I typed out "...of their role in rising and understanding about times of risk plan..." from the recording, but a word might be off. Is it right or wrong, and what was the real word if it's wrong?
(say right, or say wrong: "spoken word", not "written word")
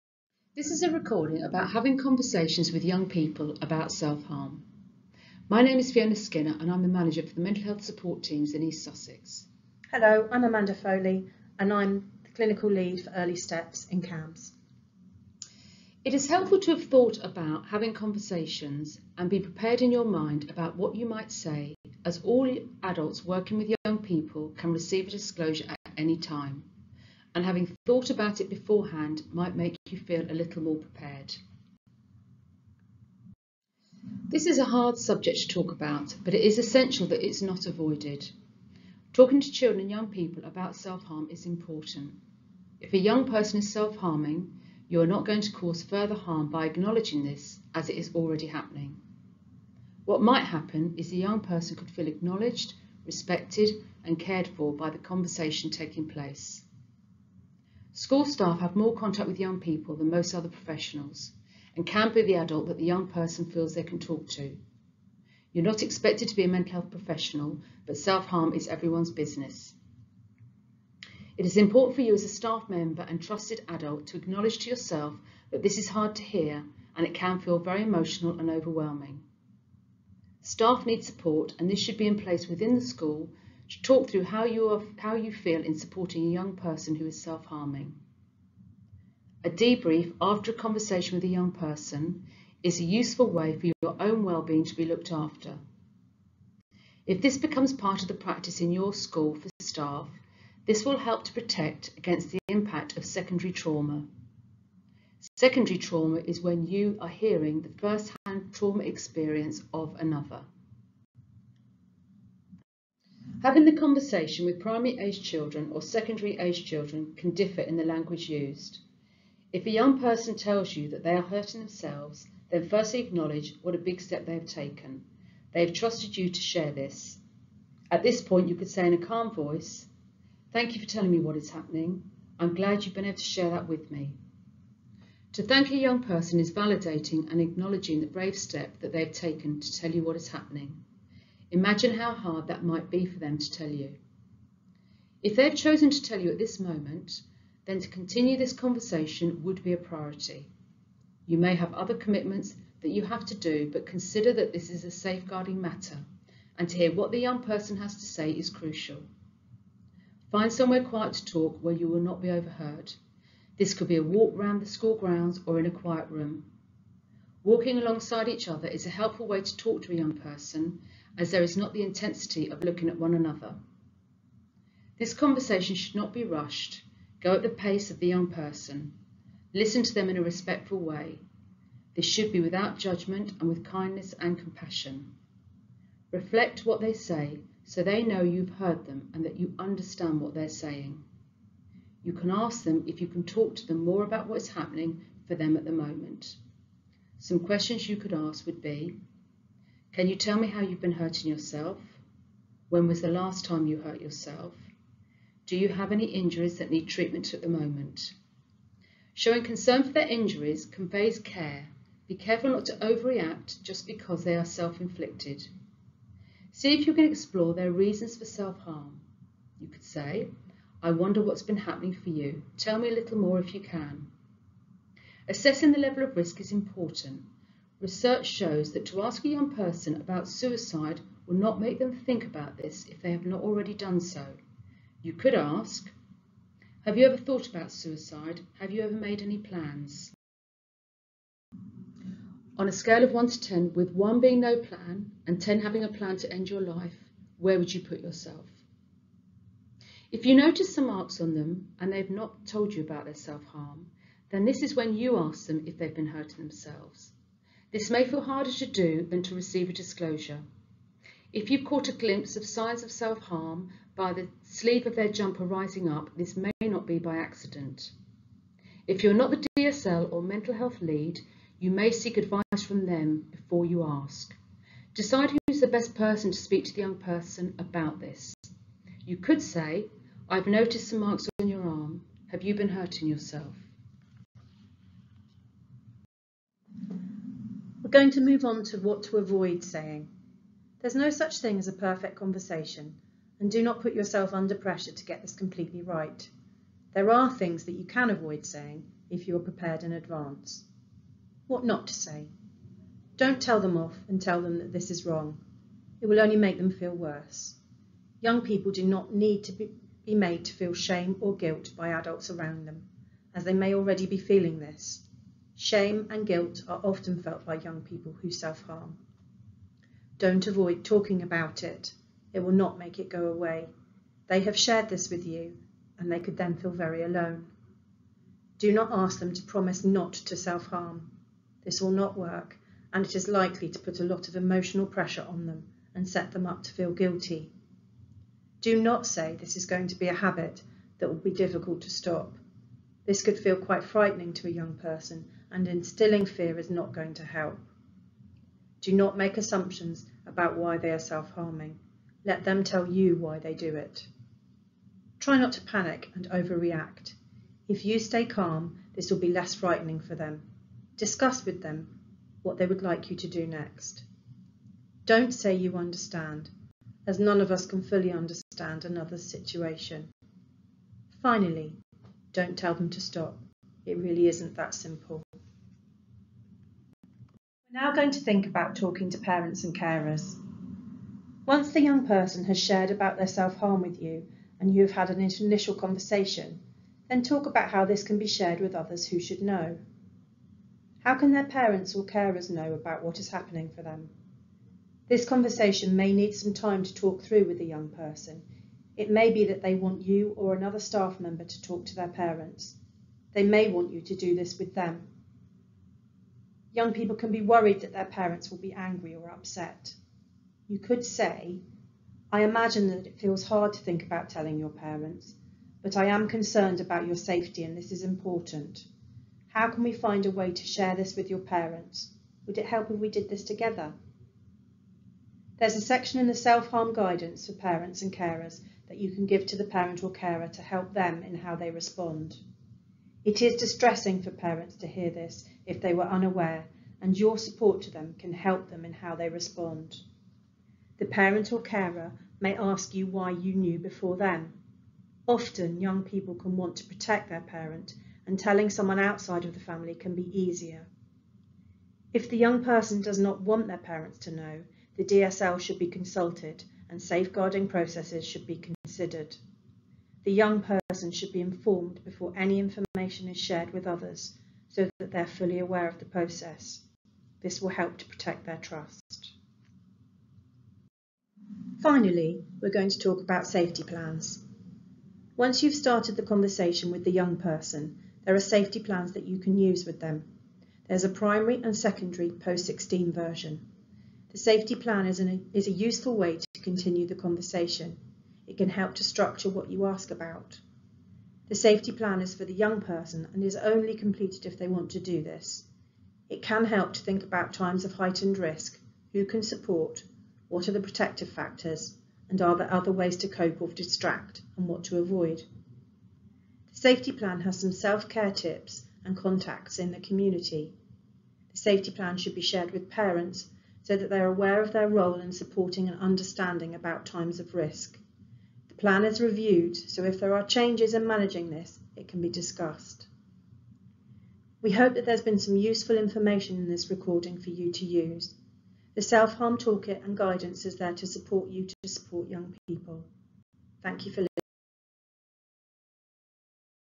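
wrong: "supporting", not "rising".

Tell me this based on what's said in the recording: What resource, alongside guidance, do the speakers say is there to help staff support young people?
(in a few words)
self-harm toolkit.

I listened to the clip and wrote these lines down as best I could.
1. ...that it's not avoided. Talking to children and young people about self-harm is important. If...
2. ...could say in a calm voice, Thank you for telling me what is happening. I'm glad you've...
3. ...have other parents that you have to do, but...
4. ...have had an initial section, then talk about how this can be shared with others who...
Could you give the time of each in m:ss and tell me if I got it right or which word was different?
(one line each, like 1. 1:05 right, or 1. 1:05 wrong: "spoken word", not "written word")
1. 0:37 right
2. 2:08 right
3. 2:31 wrong: "commitments", not "parents"
4. 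6:24 wrong: "conversation", not "section".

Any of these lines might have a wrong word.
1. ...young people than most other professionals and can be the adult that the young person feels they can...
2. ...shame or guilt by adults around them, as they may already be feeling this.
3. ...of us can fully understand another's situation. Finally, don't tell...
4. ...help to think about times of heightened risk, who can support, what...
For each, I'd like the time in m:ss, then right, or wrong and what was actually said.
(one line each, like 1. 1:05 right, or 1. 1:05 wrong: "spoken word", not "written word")
1. 0:59 right
2. 5:10 right
3. 6:07 right
4. 8:16 right.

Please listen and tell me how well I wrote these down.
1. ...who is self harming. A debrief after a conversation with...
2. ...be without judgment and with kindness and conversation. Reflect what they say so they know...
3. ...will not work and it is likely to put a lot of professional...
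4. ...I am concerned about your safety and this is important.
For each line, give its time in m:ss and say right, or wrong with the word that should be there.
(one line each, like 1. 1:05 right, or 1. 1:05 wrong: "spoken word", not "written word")
1. 1:26 right
2. 3:02 wrong: "compassion", not "conversation"
3. 5:31 wrong: "emotional", not "professional"
4. 6:55 right.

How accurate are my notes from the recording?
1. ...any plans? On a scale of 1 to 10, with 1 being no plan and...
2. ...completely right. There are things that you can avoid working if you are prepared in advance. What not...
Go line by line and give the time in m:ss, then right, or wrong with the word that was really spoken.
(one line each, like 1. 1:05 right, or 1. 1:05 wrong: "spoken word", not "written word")
1. 3:59 right
2. 4:55 wrong: "saying", not "working".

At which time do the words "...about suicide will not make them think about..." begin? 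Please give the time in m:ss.
3:49.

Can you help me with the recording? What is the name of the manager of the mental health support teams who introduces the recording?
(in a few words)
Fiona Skinner.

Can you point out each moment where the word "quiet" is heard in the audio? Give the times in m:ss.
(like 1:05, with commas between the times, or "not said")
2:40, 2:45.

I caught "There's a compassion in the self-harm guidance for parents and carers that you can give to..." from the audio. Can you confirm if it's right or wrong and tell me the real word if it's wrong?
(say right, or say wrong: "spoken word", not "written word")
wrong: "section", not "compassion".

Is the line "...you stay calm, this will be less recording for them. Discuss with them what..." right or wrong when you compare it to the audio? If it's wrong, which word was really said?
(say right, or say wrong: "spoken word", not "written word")
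wrong: "frightening", not "recording".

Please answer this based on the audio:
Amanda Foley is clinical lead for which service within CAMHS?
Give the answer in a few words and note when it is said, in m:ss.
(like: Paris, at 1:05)
early steps, at 0:13.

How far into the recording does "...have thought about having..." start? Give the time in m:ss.
0:16.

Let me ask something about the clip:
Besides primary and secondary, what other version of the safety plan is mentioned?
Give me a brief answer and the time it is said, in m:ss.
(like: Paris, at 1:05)
post-16, at 8:02.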